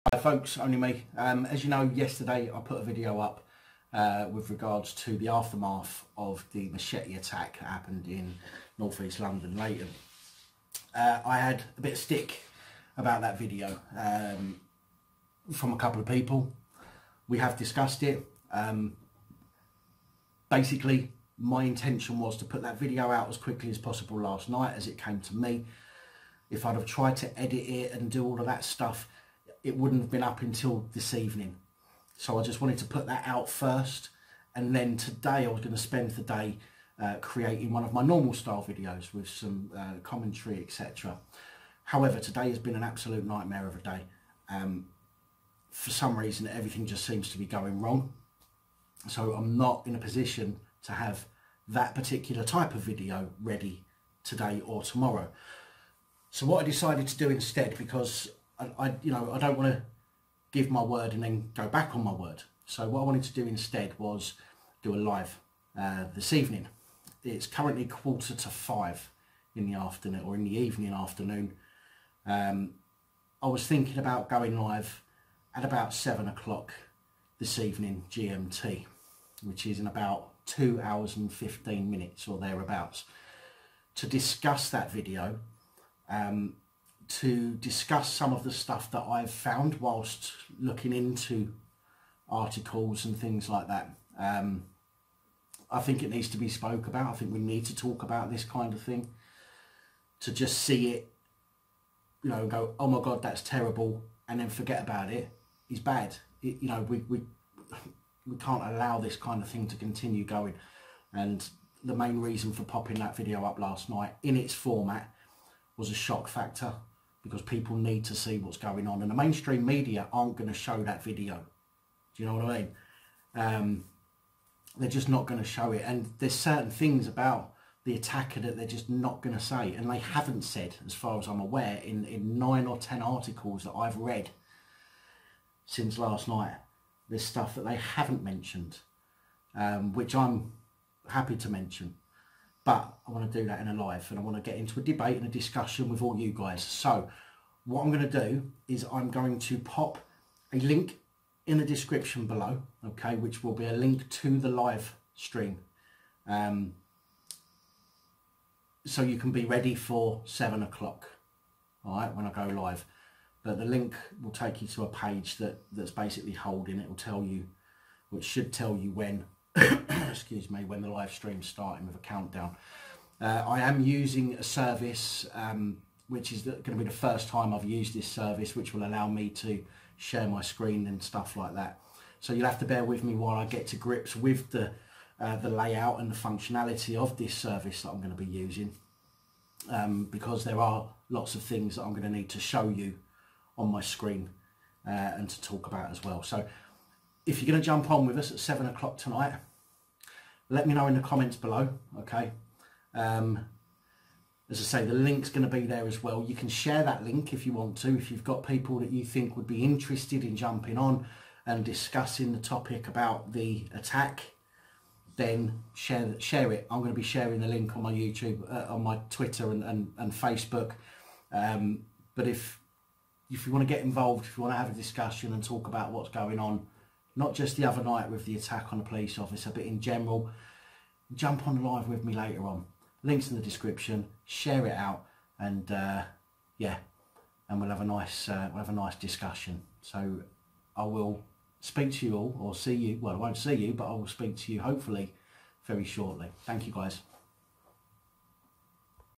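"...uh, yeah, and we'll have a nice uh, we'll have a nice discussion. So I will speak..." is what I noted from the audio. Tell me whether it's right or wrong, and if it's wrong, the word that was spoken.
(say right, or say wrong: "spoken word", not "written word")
right.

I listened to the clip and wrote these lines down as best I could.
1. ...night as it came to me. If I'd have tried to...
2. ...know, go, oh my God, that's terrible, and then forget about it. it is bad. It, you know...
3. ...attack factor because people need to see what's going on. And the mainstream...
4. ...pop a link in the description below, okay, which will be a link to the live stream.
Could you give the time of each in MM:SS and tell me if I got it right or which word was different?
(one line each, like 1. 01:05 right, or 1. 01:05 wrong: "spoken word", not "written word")
1. 00:24 right
2. 01:42 right
3. 01:55 wrong: "shock", not "attack"
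4. 02:29 right.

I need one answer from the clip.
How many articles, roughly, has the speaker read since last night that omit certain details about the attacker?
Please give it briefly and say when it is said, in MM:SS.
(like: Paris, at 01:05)
9 or 10, at 02:12.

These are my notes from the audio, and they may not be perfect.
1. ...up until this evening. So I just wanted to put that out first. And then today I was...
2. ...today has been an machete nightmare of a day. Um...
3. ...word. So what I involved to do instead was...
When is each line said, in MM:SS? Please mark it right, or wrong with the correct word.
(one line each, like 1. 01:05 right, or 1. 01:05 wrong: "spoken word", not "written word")
1. 00:30 right
2. 00:42 wrong: "absolute", not "machete"
3. 01:02 wrong: "wanted", not "involved".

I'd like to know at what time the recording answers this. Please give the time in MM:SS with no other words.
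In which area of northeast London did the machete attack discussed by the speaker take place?
00:09.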